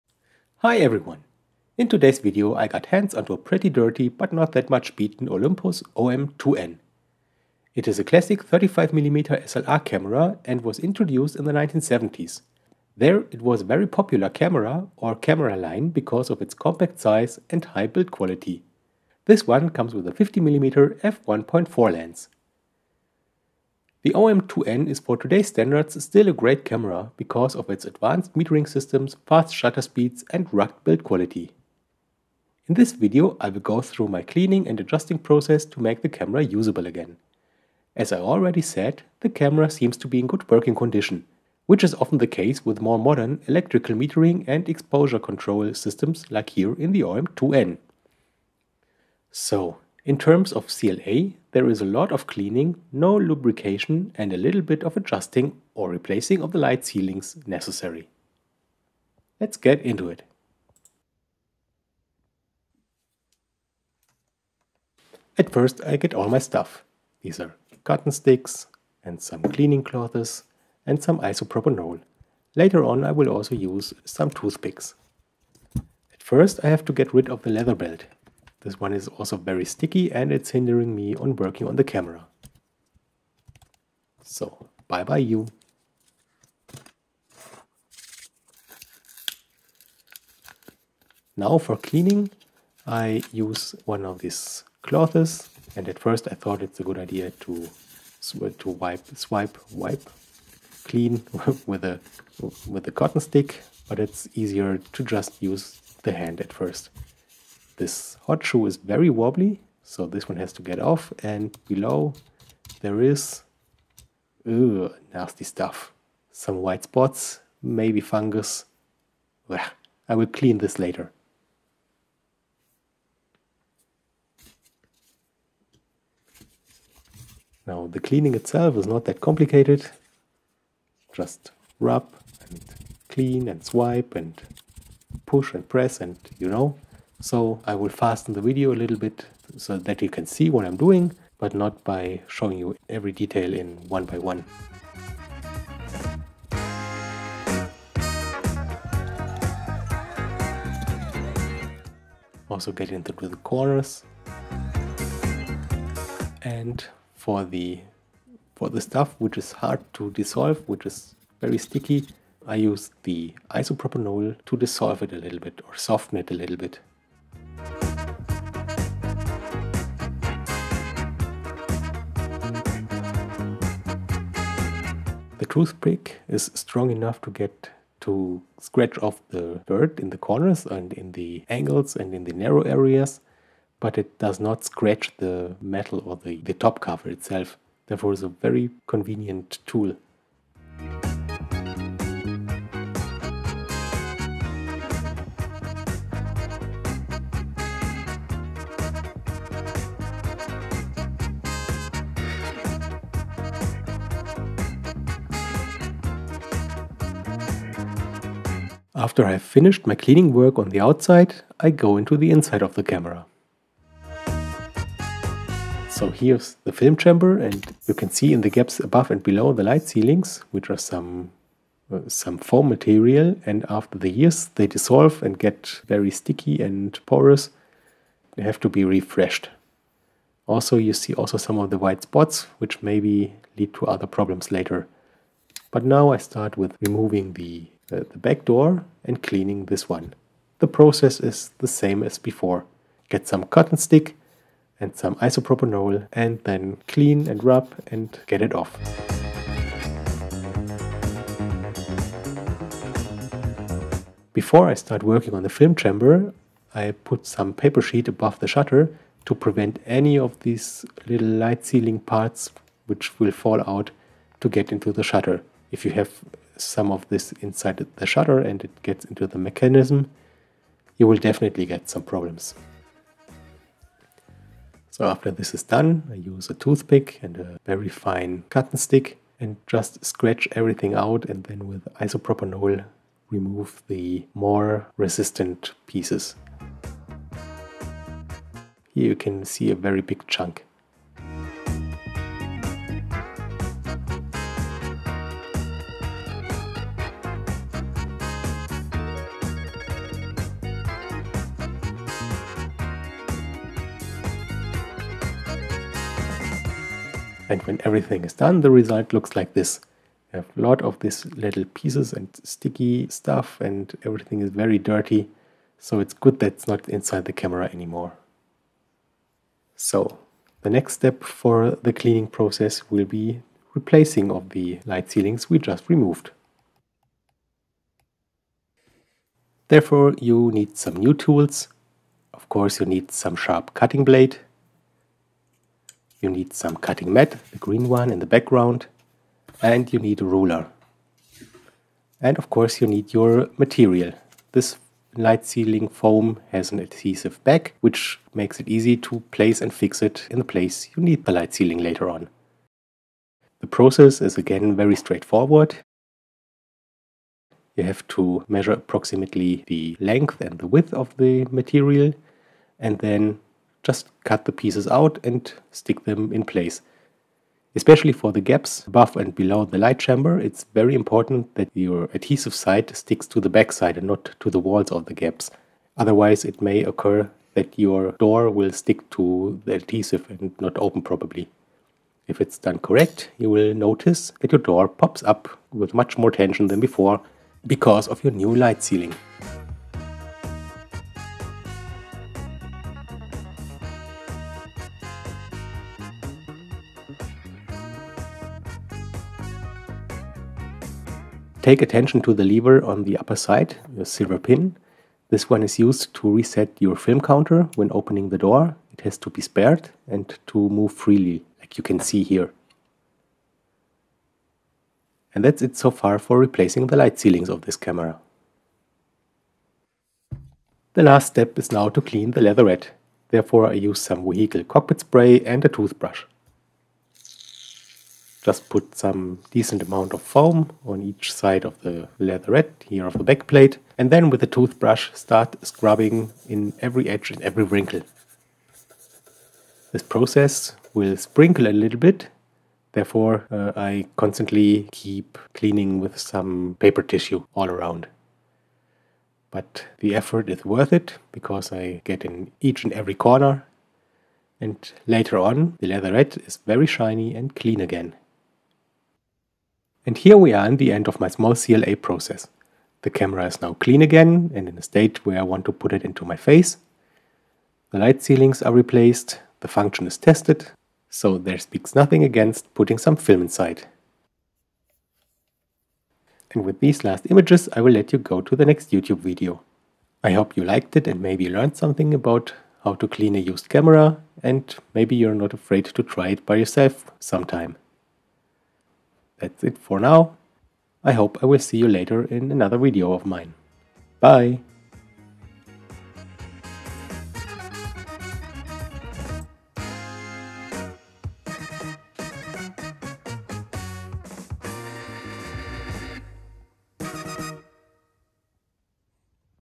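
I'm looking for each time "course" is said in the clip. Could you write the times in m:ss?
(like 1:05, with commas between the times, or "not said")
5:32, 5:42.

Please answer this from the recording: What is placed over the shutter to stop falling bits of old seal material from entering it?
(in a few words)
paper sheet.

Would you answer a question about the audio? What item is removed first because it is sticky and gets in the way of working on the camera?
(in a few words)
leather belt.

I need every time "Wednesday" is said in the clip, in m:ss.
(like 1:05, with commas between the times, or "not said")
not said.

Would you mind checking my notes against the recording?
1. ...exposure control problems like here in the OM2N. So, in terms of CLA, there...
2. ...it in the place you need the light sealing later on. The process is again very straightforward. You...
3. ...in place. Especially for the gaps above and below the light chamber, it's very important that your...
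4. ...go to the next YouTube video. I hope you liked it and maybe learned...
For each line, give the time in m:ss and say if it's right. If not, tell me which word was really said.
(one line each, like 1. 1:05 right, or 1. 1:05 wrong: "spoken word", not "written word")
1. 0:44 wrong: "systems", not "problems"
2. 5:50 right
3. 6:06 right
4. 7:58 right.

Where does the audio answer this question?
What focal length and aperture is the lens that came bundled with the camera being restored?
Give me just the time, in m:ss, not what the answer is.
0:20.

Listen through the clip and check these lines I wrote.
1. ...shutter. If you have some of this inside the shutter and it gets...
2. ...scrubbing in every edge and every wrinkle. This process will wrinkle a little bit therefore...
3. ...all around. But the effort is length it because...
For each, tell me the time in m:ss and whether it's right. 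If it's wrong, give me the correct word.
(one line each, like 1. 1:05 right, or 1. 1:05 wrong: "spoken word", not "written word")
1. 4:25 right
2. 7:15 wrong: "sprinkle", not "wrinkle"
3. 7:27 wrong: "worth", not "length".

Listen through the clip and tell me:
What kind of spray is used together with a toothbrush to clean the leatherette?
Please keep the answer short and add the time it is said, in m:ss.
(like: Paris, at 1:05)
vehicle cockpit spray, at 7:04.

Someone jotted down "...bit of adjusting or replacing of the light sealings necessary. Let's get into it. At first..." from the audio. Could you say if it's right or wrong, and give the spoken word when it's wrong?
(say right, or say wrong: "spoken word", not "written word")
right.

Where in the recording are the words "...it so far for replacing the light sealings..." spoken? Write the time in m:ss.
6:55.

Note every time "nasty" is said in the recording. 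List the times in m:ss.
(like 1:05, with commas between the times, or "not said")
1:55.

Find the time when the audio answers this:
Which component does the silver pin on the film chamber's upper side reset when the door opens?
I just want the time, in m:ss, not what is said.
6:46.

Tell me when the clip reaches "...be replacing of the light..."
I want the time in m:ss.
5:23.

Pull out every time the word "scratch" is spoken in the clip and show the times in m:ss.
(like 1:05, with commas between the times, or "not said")
2:58, 3:04, 4:40.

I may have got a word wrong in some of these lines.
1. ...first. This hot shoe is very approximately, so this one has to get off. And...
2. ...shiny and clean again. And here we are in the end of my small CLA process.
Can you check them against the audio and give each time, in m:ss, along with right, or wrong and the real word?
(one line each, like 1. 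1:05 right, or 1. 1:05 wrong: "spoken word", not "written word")
1. 1:46 wrong: "wobbly", not "approximately"
2. 7:36 right.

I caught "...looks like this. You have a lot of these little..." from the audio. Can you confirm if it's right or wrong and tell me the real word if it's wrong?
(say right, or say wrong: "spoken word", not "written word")
right.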